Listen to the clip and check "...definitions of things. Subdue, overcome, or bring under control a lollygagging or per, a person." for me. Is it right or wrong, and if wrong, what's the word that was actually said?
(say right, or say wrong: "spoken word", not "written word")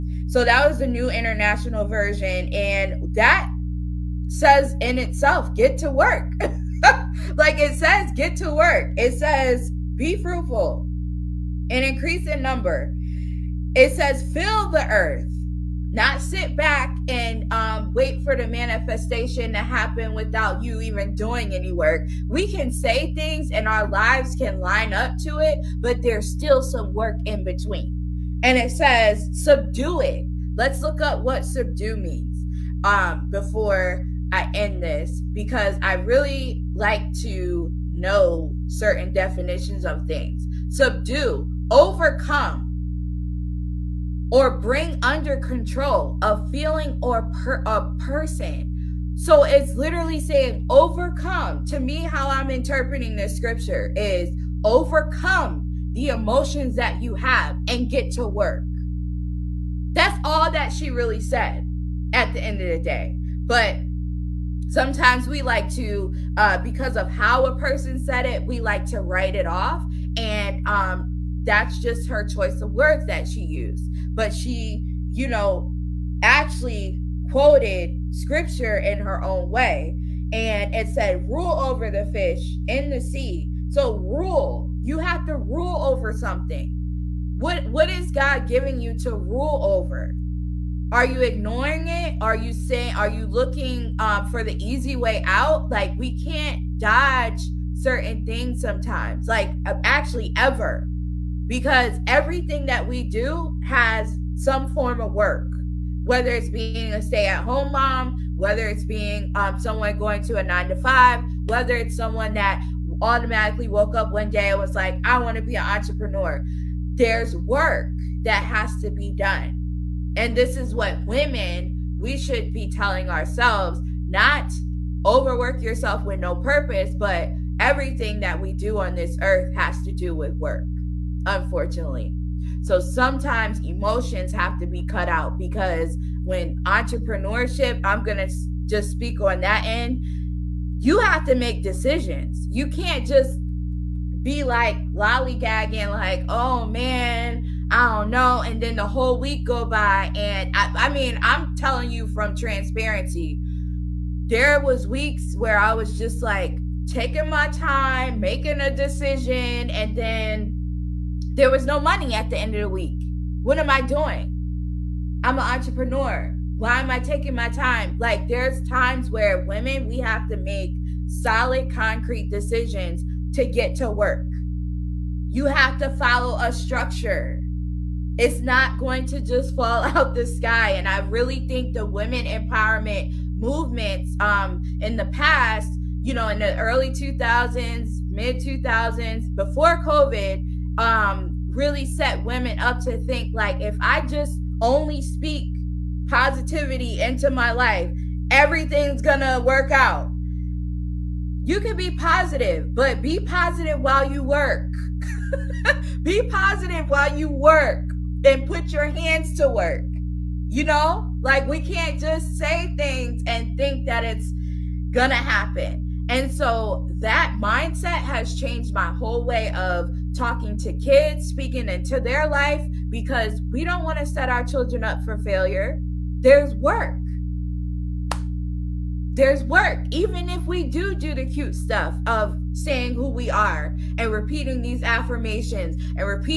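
wrong: "feeling", not "lollygagging".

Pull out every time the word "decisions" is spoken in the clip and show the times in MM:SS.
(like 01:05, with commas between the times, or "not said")
02:21, 02:38, 02:52.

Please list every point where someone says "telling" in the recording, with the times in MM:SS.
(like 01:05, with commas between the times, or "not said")
02:02, 02:31.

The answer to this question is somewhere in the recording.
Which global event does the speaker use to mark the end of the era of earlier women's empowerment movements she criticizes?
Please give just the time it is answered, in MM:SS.
03:09.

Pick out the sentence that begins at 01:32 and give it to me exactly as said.
Are you saying, are you looking um, for the easy way out?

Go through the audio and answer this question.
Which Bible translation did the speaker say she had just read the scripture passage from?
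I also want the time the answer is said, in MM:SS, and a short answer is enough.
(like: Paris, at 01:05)
New International Version, at 00:00.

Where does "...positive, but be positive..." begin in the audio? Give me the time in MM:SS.
03:21.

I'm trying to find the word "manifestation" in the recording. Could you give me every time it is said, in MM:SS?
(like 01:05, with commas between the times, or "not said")
00:18.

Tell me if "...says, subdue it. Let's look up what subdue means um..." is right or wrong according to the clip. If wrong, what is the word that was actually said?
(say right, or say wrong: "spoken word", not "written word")
right.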